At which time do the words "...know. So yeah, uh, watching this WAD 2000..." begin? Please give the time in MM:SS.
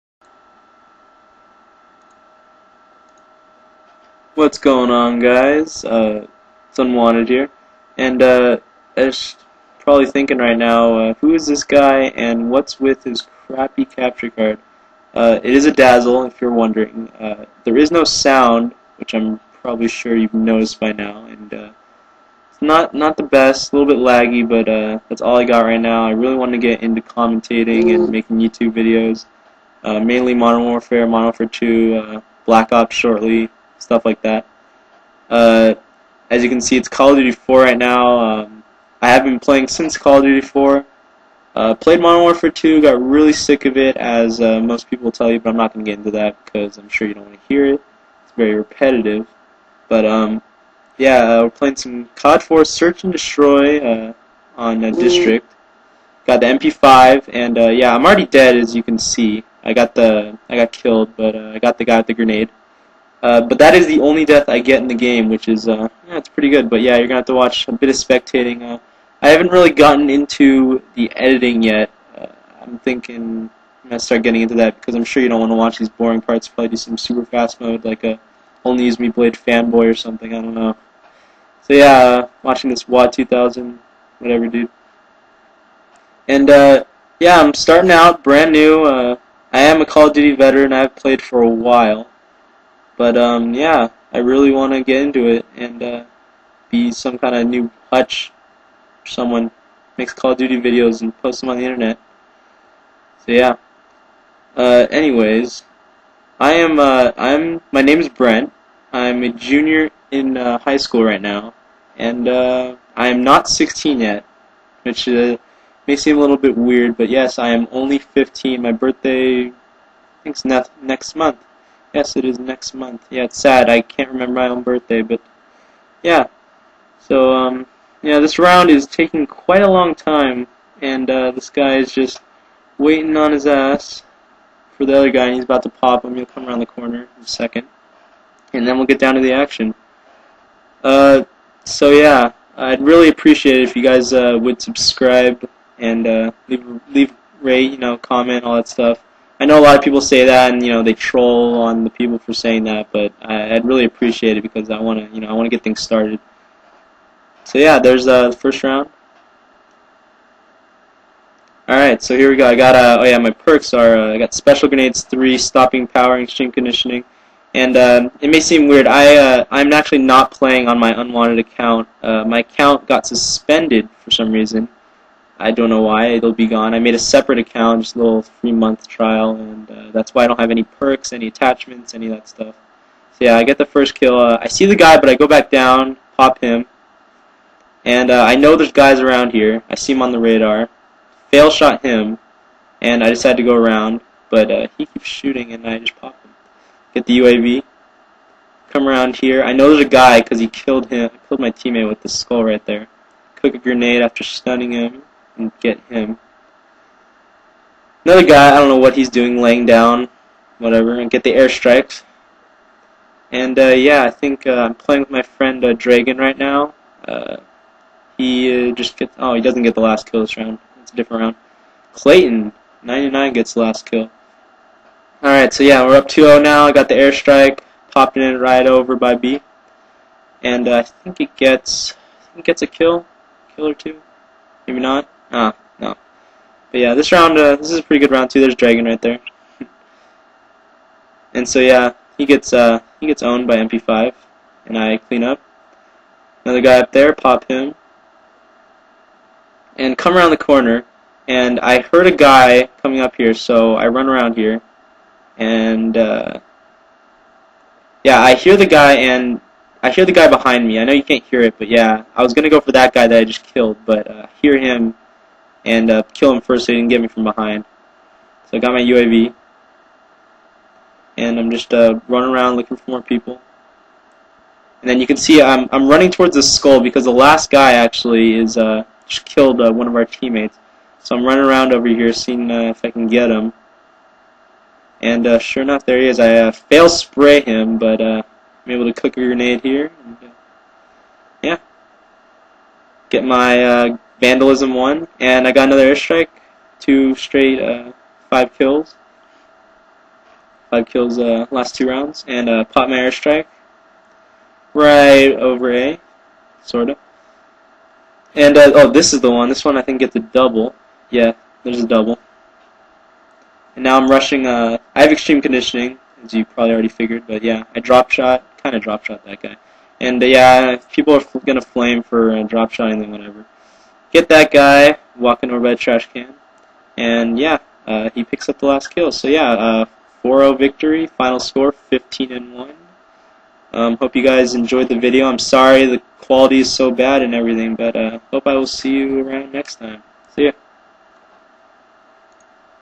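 01:20.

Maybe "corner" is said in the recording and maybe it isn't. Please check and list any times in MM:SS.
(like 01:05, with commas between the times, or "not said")
02:16, 04:10.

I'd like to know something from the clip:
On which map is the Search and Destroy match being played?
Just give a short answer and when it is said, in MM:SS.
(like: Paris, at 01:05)
District, at 00:55.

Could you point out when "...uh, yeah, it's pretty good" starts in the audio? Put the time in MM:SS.
01:05.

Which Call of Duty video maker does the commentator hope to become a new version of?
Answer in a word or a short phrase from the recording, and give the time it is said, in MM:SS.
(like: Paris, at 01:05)
Hutch, at 01:37.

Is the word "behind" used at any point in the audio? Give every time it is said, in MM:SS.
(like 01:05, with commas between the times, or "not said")
04:20, 04:27.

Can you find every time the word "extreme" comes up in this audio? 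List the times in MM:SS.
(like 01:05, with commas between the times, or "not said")
02:46, 05:15.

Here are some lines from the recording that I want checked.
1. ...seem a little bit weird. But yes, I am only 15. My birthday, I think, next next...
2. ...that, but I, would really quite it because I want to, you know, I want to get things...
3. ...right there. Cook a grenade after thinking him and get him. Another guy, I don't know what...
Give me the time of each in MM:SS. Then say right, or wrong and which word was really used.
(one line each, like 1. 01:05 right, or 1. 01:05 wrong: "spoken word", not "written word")
1. 01:55 right
2. 02:32 wrong: "appreciate", not "quite"
3. 03:22 wrong: "stunning", not "thinking".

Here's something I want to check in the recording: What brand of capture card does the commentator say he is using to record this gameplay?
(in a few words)
Dazzle.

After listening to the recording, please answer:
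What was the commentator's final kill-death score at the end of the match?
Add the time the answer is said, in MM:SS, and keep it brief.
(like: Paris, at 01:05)
15 and 1, at 05:31.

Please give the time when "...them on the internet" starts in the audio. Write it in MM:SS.
01:41.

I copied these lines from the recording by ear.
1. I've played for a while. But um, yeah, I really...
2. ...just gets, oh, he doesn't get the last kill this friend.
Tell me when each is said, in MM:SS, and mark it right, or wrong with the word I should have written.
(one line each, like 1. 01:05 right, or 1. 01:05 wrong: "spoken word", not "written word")
1. 01:30 right
2. 03:38 wrong: "round", not "friend".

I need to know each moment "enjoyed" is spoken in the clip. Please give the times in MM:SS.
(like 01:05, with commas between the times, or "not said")
05:34.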